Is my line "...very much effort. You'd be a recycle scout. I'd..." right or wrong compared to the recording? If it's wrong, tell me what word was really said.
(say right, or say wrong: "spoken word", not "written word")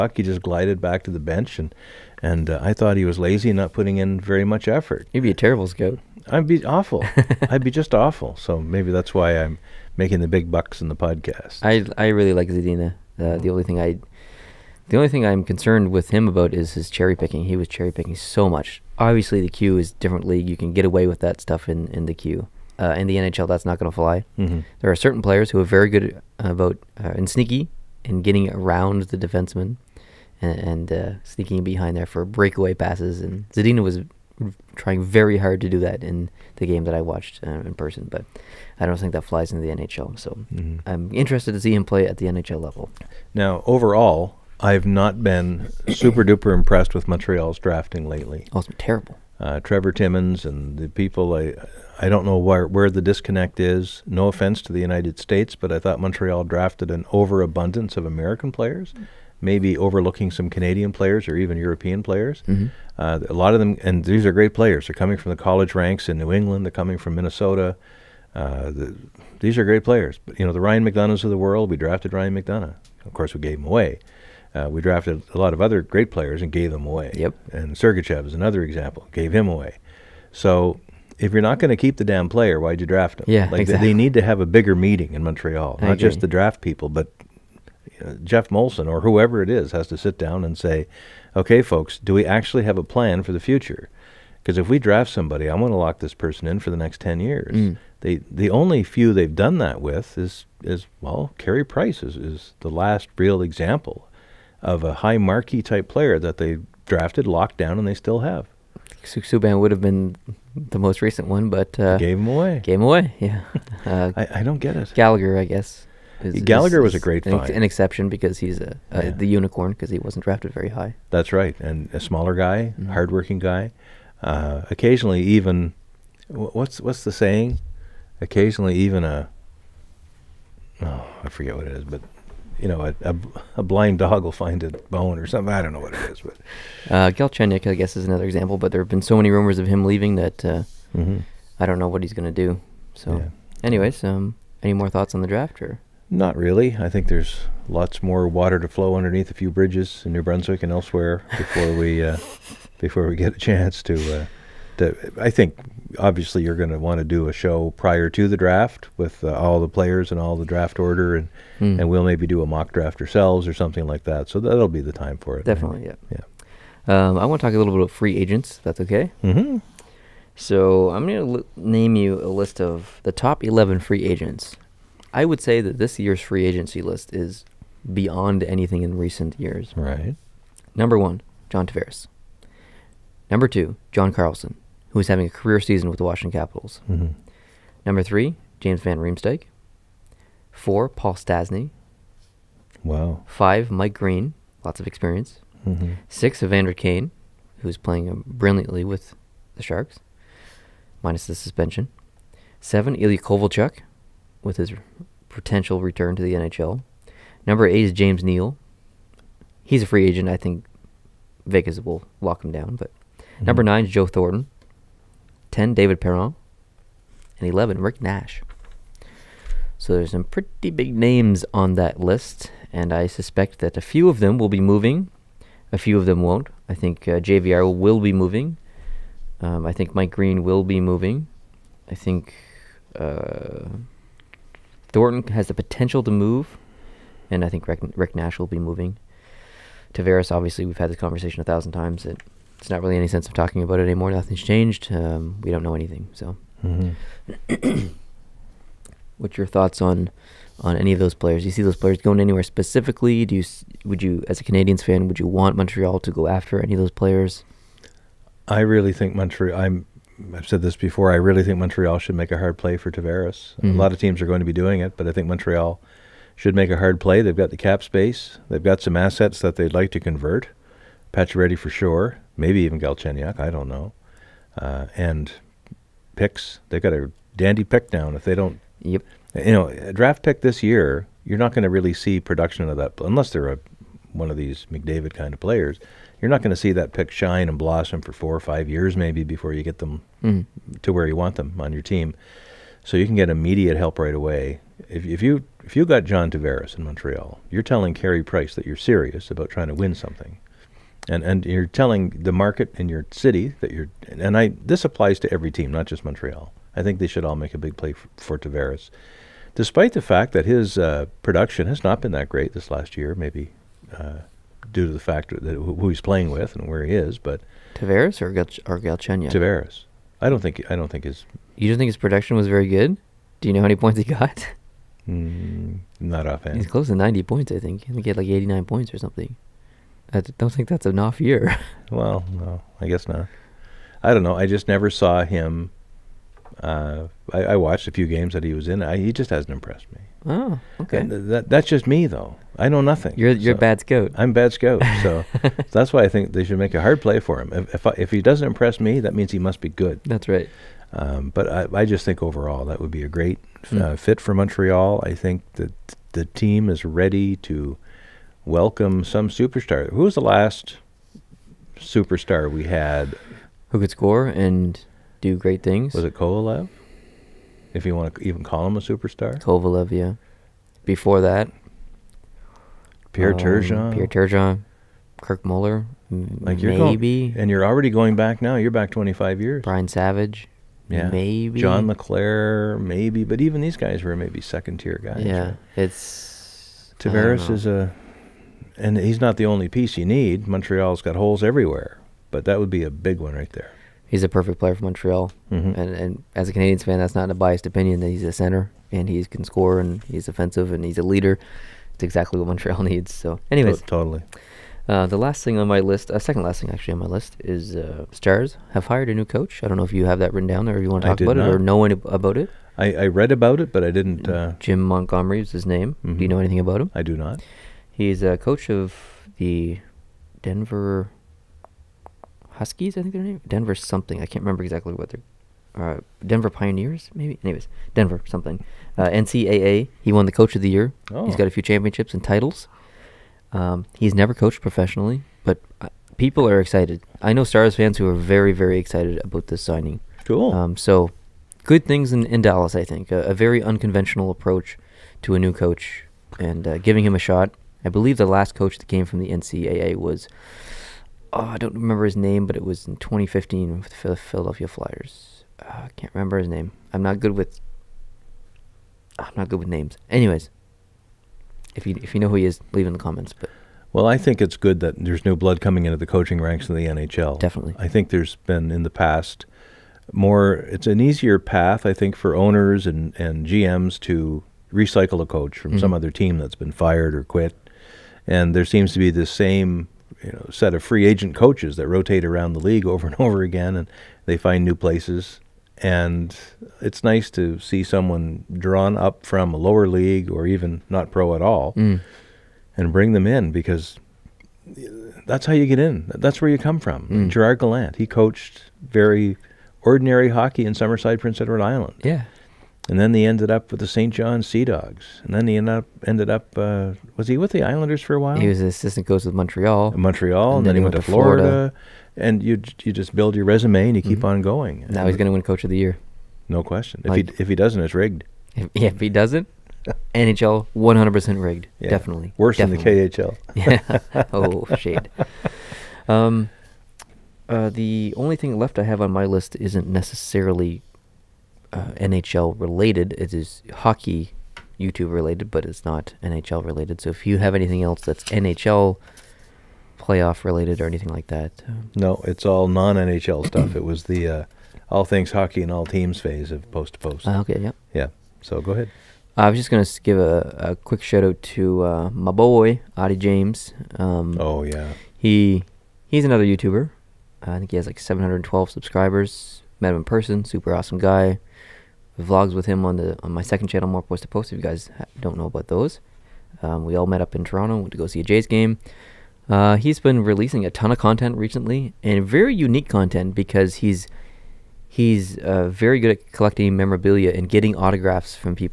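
wrong: "terrible", not "recycle".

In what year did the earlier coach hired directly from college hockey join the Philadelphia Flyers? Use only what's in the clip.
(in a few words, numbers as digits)
2015.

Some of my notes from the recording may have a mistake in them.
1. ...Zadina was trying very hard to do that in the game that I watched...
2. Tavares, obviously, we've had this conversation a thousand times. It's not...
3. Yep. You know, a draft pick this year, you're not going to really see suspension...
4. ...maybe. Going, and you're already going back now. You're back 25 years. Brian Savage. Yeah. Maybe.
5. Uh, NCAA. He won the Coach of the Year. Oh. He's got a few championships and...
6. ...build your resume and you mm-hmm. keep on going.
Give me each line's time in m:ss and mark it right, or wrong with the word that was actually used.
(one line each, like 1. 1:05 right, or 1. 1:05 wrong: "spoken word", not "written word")
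1. 0:33 right
2. 3:59 right
3. 4:38 wrong: "production", not "suspension"
4. 6:16 right
5. 7:08 right
6. 8:33 right.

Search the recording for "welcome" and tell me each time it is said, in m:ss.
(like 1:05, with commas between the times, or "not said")
5:58.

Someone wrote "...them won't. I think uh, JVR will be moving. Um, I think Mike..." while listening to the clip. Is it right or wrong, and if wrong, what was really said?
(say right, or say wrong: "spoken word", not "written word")
right.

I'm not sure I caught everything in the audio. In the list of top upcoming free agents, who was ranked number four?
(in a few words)
Paul Stastny.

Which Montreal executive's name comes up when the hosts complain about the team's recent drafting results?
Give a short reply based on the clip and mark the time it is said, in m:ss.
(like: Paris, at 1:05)
Trevor Timmins, at 0:49.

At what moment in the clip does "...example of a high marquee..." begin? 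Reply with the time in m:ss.
1:43.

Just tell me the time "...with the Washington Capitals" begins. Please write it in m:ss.
3:05.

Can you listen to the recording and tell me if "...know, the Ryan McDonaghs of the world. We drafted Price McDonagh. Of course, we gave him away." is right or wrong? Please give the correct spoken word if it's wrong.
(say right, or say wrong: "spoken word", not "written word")
wrong: "Ryan", not "Price".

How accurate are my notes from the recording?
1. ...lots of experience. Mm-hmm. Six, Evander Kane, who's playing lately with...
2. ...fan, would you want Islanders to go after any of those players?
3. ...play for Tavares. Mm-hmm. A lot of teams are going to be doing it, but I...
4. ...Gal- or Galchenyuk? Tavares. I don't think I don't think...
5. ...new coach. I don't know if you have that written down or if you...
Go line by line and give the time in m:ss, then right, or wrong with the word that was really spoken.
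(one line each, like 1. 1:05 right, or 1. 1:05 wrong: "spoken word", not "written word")
1. 3:14 wrong: "brilliantly", not "lately"
2. 4:14 wrong: "Montreal", not "Islanders"
3. 4:22 right
4. 5:18 right
5. 6:49 right.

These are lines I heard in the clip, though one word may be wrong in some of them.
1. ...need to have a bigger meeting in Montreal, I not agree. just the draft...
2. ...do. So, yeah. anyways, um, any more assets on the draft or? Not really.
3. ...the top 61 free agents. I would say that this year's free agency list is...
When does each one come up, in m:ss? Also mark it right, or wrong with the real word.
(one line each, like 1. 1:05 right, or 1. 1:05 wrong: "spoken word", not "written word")
1. 1:23 right
2. 2:22 wrong: "thoughts", not "assets"
3. 2:53 wrong: "11", not "61".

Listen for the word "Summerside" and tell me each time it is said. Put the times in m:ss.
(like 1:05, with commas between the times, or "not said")
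8:20.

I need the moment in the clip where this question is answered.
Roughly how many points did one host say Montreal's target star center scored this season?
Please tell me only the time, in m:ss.
5:28.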